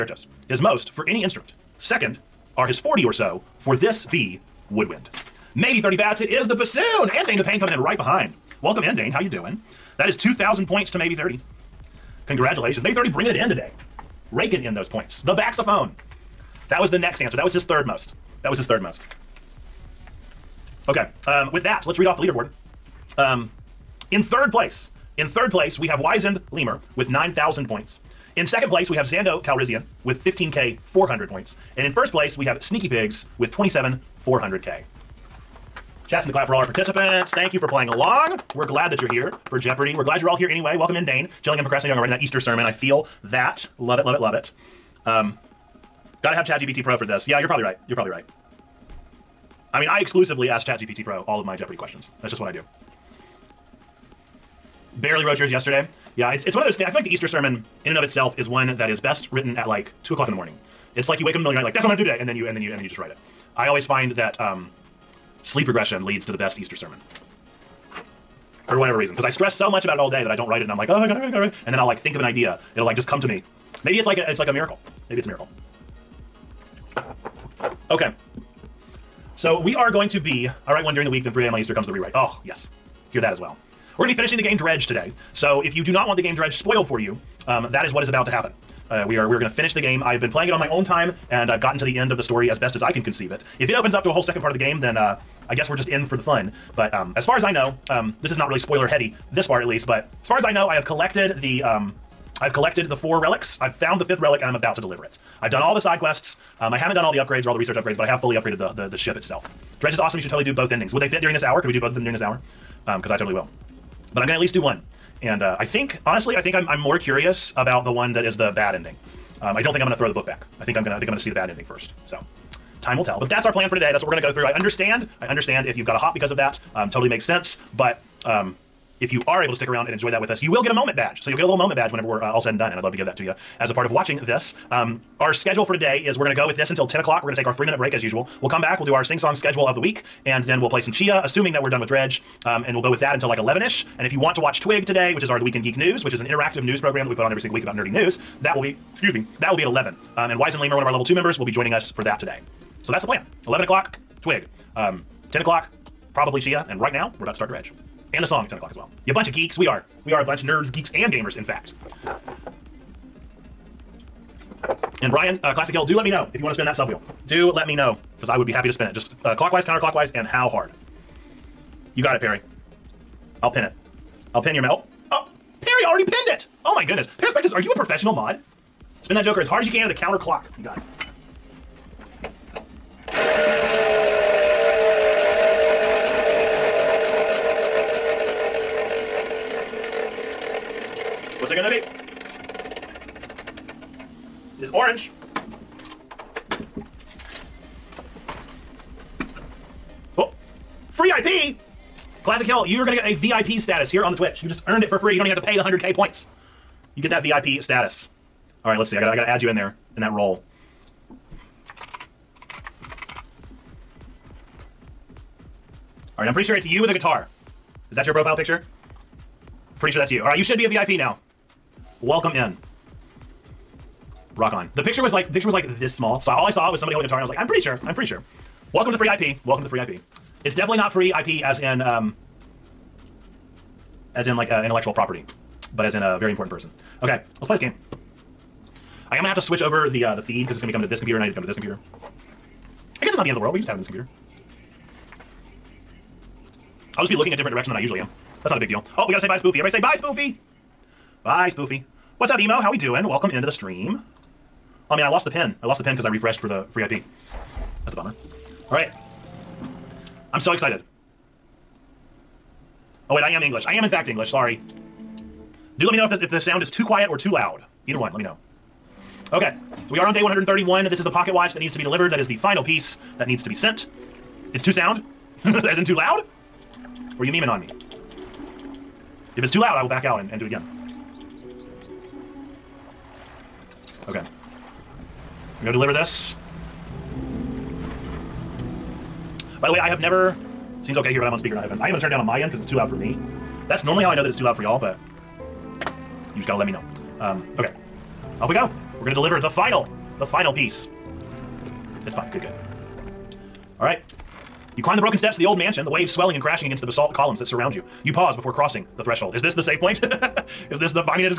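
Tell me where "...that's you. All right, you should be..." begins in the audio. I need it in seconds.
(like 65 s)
219 s.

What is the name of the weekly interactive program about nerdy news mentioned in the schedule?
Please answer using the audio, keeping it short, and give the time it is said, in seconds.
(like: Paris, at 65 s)
The Weekend Geek News, at 145 s.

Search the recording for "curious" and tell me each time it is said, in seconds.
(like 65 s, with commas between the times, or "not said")
116 s.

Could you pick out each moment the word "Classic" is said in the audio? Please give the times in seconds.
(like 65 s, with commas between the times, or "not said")
165 s, 202 s.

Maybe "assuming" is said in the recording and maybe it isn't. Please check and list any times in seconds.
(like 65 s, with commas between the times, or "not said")
141 s.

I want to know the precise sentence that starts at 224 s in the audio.
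The picture was like picture was like this small.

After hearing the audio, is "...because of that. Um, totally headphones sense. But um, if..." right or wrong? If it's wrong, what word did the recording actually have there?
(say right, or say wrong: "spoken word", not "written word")
wrong: "makes", not "headphones".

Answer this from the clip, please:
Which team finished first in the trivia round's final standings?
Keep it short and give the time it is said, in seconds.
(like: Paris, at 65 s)
Sneaky Pigs, at 32 s.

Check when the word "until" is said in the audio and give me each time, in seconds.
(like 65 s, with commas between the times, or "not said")
136 s, 143 s.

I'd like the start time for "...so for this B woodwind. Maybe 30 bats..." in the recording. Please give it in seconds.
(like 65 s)
3 s.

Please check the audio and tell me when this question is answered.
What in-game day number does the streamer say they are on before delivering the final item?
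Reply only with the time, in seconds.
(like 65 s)
270 s.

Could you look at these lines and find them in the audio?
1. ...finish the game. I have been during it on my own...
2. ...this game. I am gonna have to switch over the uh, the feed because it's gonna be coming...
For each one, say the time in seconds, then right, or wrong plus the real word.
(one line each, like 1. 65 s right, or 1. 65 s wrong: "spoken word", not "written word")
1. 89 s wrong: "playing", not "during"
2. 237 s right.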